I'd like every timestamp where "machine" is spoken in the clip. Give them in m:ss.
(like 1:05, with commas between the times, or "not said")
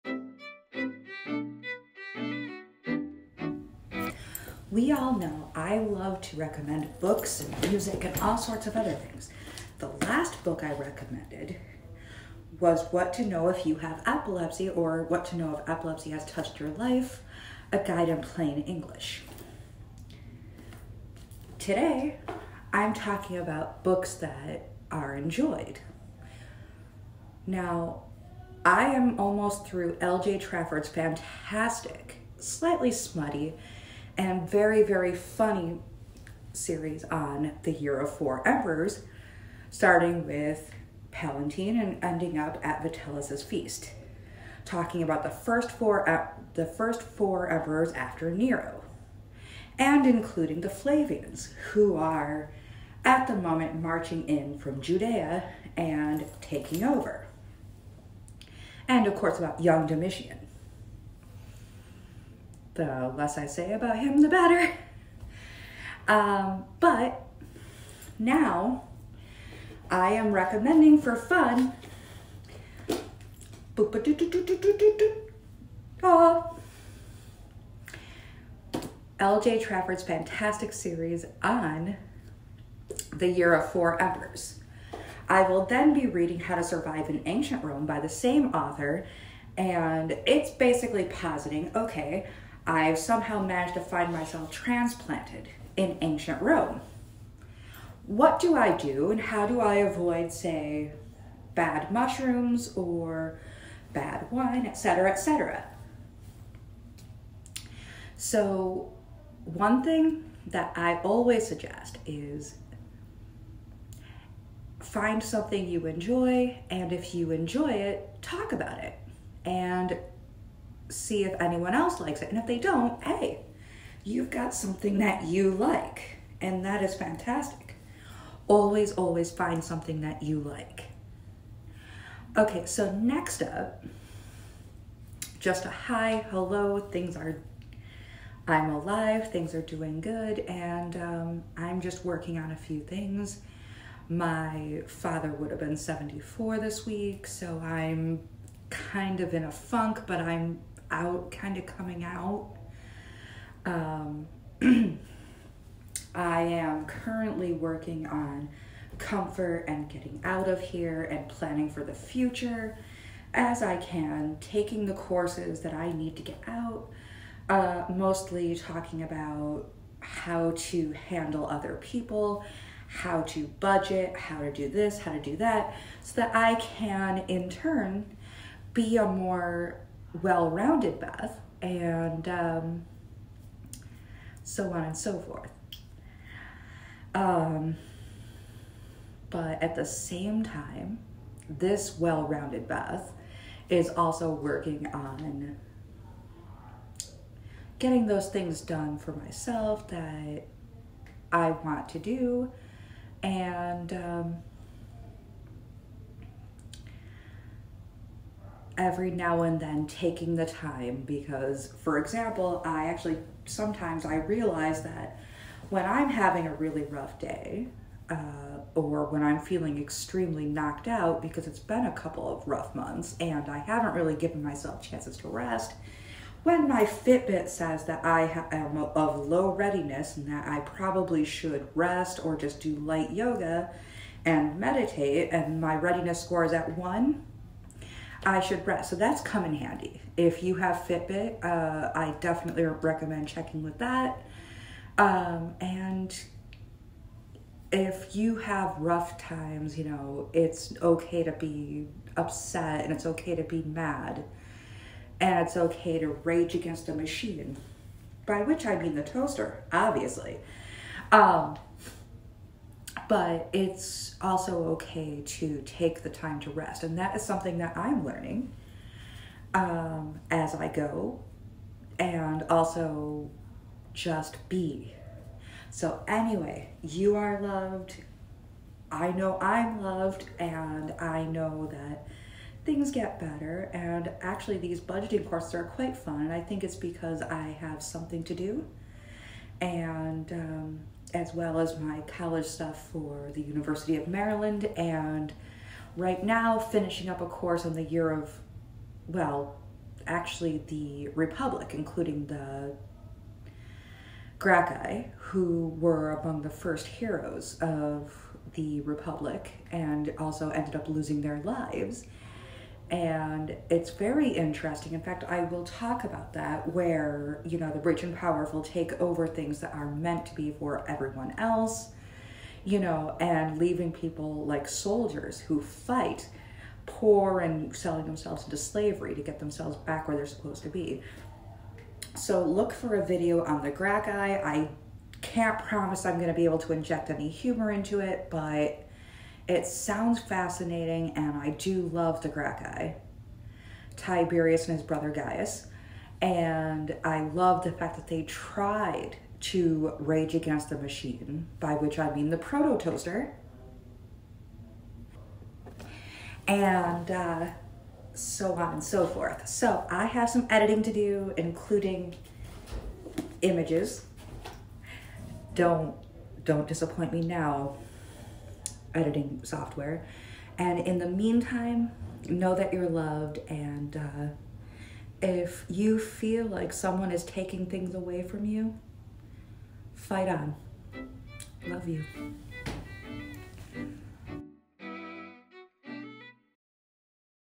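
4:16, 5:50.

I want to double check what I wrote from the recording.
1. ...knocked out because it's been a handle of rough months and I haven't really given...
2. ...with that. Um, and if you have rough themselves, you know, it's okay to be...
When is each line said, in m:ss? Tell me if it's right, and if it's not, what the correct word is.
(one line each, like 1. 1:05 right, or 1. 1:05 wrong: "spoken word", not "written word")
1. 3:40 wrong: "couple", not "handle"
2. 4:03 wrong: "times", not "themselves".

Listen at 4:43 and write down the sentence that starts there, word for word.
And actually, these budgeting courses are quite fun.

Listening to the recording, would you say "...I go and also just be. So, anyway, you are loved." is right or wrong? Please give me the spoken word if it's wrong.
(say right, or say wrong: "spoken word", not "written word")
right.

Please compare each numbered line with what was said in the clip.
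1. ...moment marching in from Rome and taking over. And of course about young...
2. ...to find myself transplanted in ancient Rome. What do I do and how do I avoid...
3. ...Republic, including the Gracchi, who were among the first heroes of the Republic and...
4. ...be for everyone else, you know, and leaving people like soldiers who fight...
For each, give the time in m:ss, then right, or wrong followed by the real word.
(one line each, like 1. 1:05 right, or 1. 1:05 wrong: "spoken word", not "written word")
1. 0:53 wrong: "Judea", not "Rome"
2. 1:33 right
3. 5:01 right
4. 5:20 right.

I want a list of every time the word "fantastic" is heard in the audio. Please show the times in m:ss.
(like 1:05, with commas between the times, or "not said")
0:30, 1:20, 2:06.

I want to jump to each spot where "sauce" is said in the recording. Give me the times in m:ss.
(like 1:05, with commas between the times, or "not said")
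not said.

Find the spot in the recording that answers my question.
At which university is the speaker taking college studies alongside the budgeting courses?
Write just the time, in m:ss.
4:53.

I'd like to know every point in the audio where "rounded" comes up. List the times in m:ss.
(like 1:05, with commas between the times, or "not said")
3:00, 3:11.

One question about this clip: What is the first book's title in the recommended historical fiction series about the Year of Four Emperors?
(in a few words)
Palatine.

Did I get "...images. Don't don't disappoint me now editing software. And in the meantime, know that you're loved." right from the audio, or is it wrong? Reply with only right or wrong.
right.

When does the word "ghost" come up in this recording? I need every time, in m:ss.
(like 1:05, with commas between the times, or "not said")
not said.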